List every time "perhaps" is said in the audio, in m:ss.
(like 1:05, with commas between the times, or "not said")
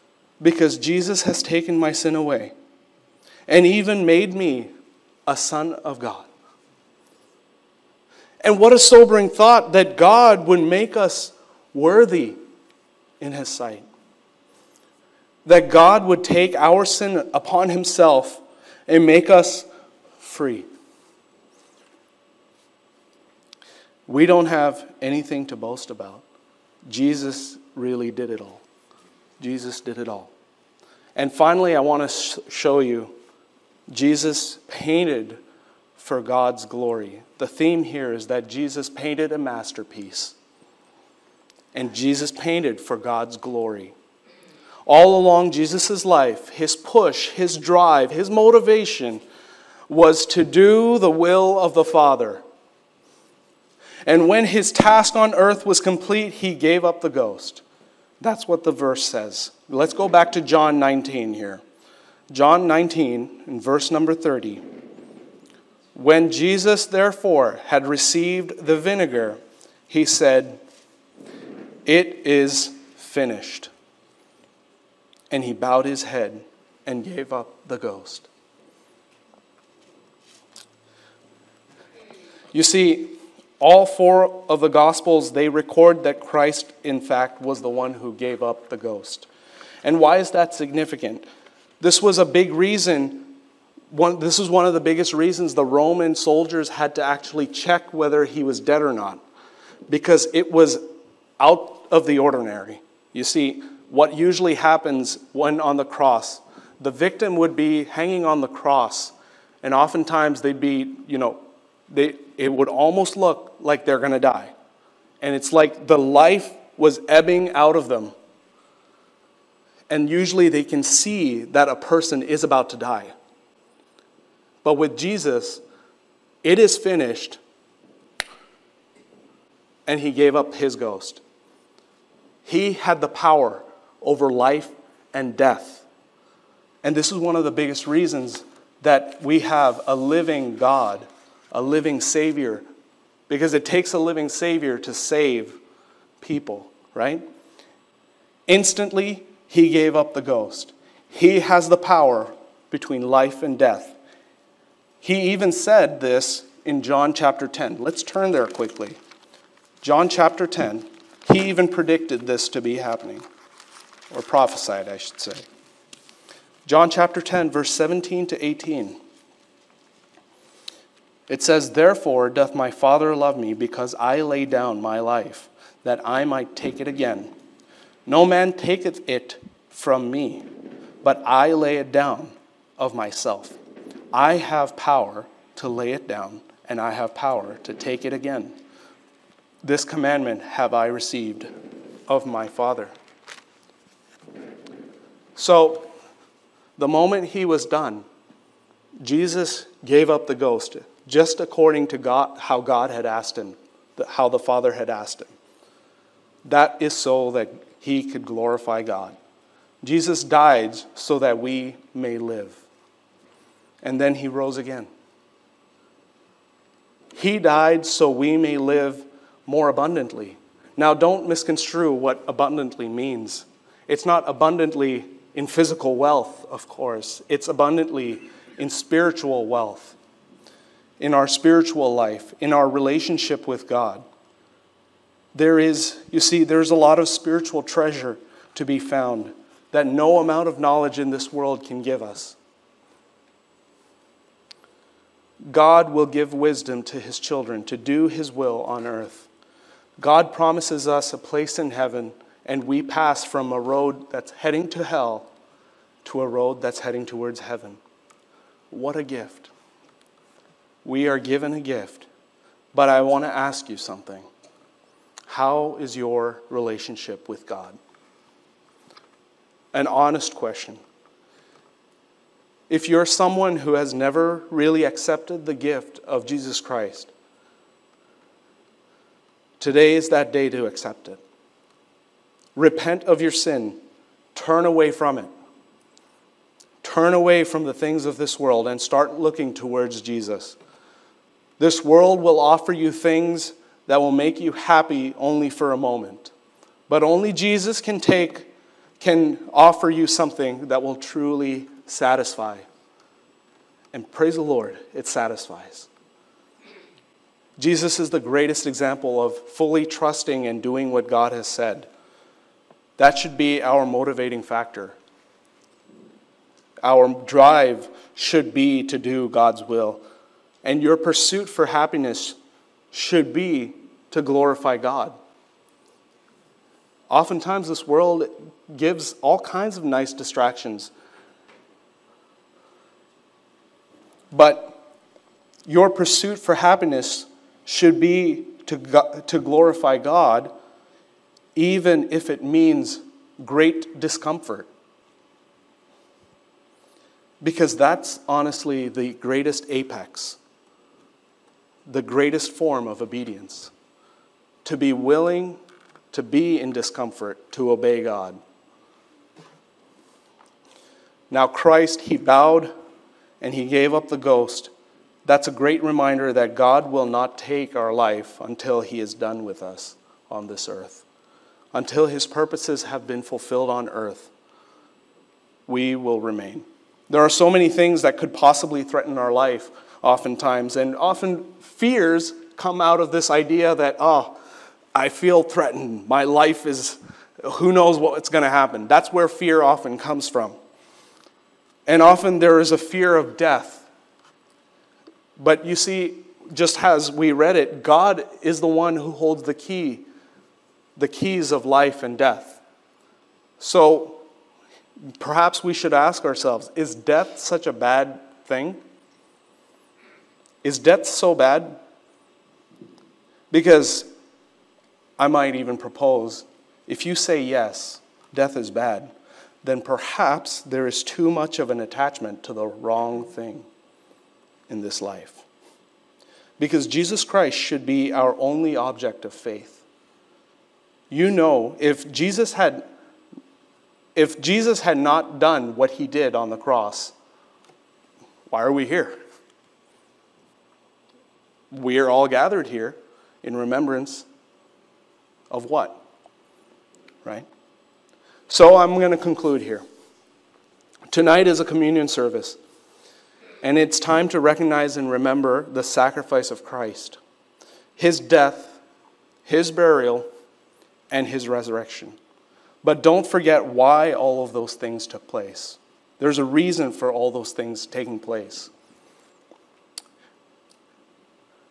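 6:45, 6:59.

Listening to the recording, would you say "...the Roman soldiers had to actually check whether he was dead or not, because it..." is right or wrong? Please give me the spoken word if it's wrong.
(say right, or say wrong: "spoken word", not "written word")
right.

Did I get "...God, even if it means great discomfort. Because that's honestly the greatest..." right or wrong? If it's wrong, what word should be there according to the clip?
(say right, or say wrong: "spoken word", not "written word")
right.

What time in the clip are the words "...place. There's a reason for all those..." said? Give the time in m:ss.
7:45.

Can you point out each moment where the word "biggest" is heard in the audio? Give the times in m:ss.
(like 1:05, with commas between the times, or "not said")
1:34, 2:17.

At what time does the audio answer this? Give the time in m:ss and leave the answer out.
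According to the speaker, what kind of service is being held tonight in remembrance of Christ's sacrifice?
7:31.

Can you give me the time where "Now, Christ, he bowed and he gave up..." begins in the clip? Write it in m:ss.
6:01.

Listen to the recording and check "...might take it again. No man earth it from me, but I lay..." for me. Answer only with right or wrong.
wrong.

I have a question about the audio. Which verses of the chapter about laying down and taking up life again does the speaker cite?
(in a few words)
17 to 18.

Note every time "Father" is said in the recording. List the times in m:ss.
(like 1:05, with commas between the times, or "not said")
0:51, 2:52, 3:12, 3:24.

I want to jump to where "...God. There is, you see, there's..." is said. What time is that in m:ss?
3:53.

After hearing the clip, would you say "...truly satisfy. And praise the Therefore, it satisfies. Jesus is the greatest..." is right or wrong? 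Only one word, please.
wrong.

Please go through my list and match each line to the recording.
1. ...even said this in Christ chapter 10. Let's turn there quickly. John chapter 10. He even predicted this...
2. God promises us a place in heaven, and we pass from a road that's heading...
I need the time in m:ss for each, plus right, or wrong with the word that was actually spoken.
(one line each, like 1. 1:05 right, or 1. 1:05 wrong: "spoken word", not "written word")
1. 2:35 wrong: "John", not "Christ"
2. 4:09 right.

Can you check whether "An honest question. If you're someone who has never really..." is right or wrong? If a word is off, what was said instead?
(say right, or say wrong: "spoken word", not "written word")
right.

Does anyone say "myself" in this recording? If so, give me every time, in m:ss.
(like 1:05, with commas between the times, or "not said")
3:02.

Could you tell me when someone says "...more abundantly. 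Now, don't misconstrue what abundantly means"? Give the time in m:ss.
3:39.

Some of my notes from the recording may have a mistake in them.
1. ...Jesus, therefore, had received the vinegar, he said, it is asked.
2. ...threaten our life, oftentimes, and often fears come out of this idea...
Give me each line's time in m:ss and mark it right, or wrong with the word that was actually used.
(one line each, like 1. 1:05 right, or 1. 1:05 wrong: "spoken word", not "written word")
1. 1:06 wrong: "finished", not "asked"
2. 6:18 right.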